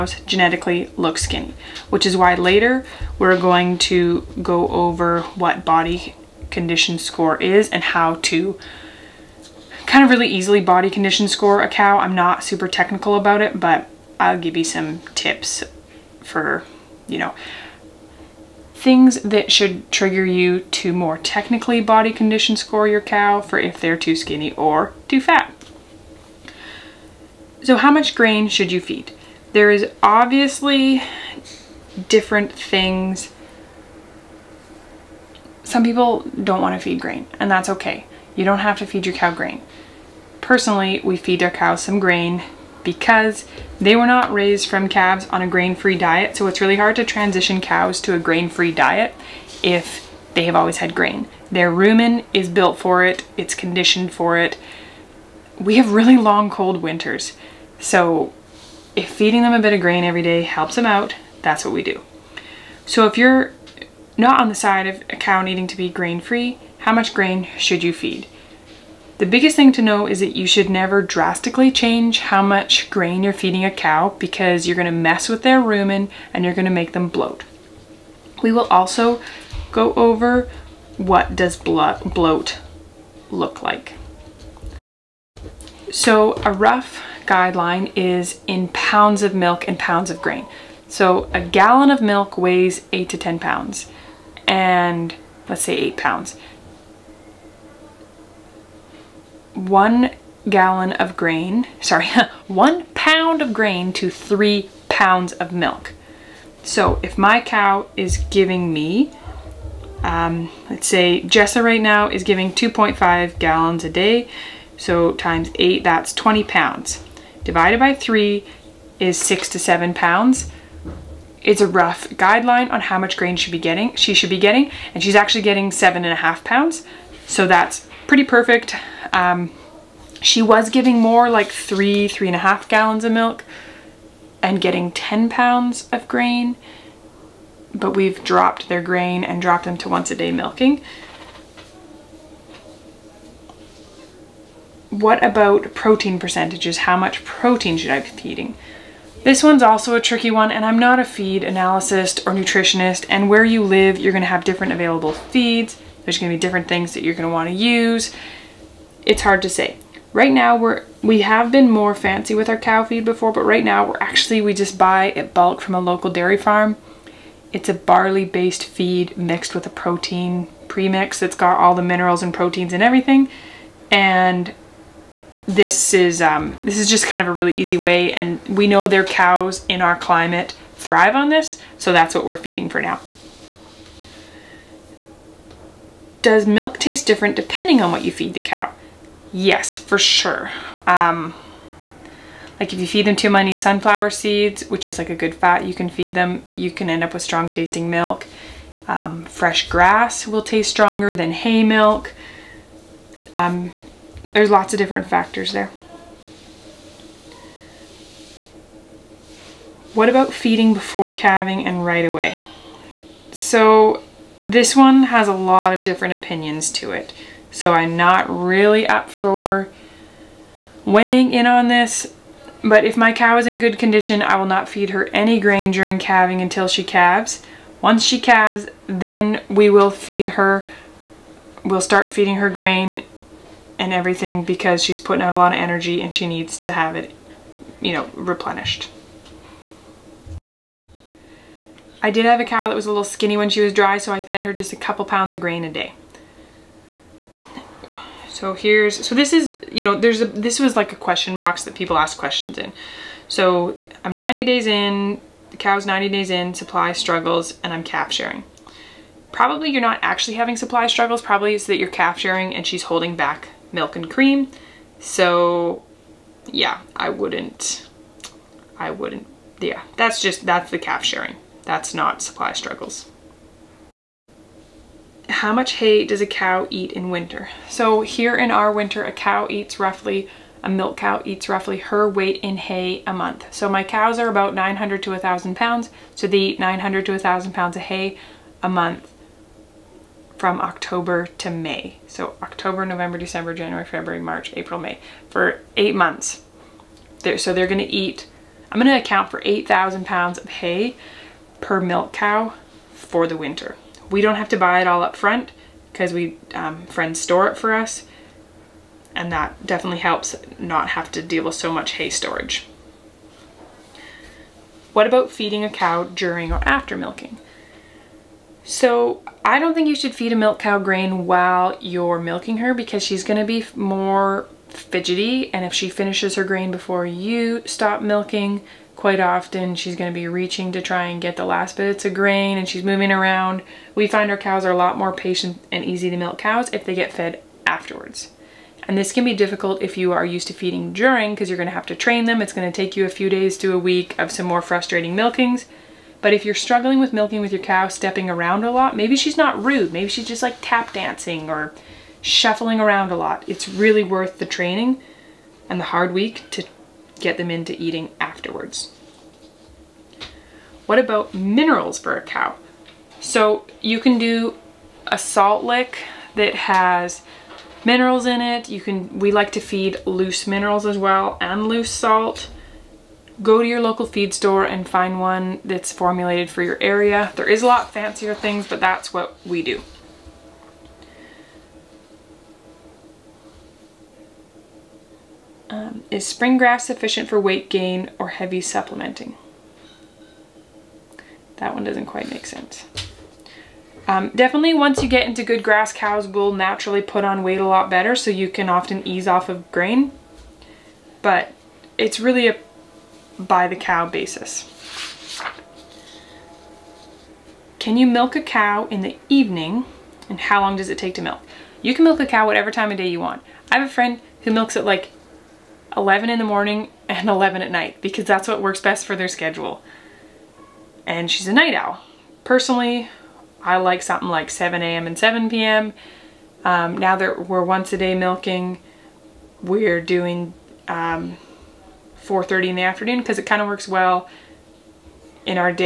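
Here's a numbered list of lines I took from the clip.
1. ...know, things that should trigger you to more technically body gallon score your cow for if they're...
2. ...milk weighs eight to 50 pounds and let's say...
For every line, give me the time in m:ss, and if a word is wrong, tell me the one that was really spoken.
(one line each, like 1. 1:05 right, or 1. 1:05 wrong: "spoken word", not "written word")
1. 0:17 wrong: "condition", not "gallon"
2. 1:31 wrong: "10", not "50".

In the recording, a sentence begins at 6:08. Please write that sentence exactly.
You can, we like to feed loose minerals as well and loose salt.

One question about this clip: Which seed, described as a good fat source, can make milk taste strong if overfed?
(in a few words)
Sunflower seeds.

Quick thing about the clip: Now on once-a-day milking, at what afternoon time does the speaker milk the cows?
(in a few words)
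4:30.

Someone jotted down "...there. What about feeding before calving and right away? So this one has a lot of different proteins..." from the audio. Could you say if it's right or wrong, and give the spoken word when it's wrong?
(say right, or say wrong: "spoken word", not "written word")
wrong: "opinions", not "proteins".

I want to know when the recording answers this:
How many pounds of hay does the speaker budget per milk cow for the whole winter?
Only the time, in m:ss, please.
4:59.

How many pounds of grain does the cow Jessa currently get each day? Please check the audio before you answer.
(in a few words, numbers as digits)
7.5 pounds.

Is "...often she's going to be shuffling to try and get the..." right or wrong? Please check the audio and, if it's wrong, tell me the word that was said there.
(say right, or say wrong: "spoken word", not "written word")
wrong: "reaching", not "shuffling".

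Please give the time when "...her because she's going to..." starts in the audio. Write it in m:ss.
5:22.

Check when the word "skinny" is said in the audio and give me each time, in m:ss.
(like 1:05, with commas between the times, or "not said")
0:01, 0:24, 4:03.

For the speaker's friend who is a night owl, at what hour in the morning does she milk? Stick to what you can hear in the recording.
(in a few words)
11.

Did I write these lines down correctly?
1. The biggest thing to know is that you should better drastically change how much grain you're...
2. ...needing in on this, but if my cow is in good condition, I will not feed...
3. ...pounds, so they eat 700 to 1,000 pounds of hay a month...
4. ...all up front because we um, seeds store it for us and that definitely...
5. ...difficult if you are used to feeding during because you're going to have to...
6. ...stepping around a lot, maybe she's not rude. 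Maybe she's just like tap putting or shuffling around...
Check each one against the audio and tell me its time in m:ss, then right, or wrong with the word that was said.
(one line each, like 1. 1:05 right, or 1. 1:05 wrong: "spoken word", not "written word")
1. 1:09 wrong: "never", not "better"
2. 3:40 wrong: "weighing", not "needing"
3. 4:45 wrong: "900", not "700"
4. 5:04 wrong: "friends", not "seeds"
5. 5:39 right
6. 5:47 wrong: "dancing", not "putting".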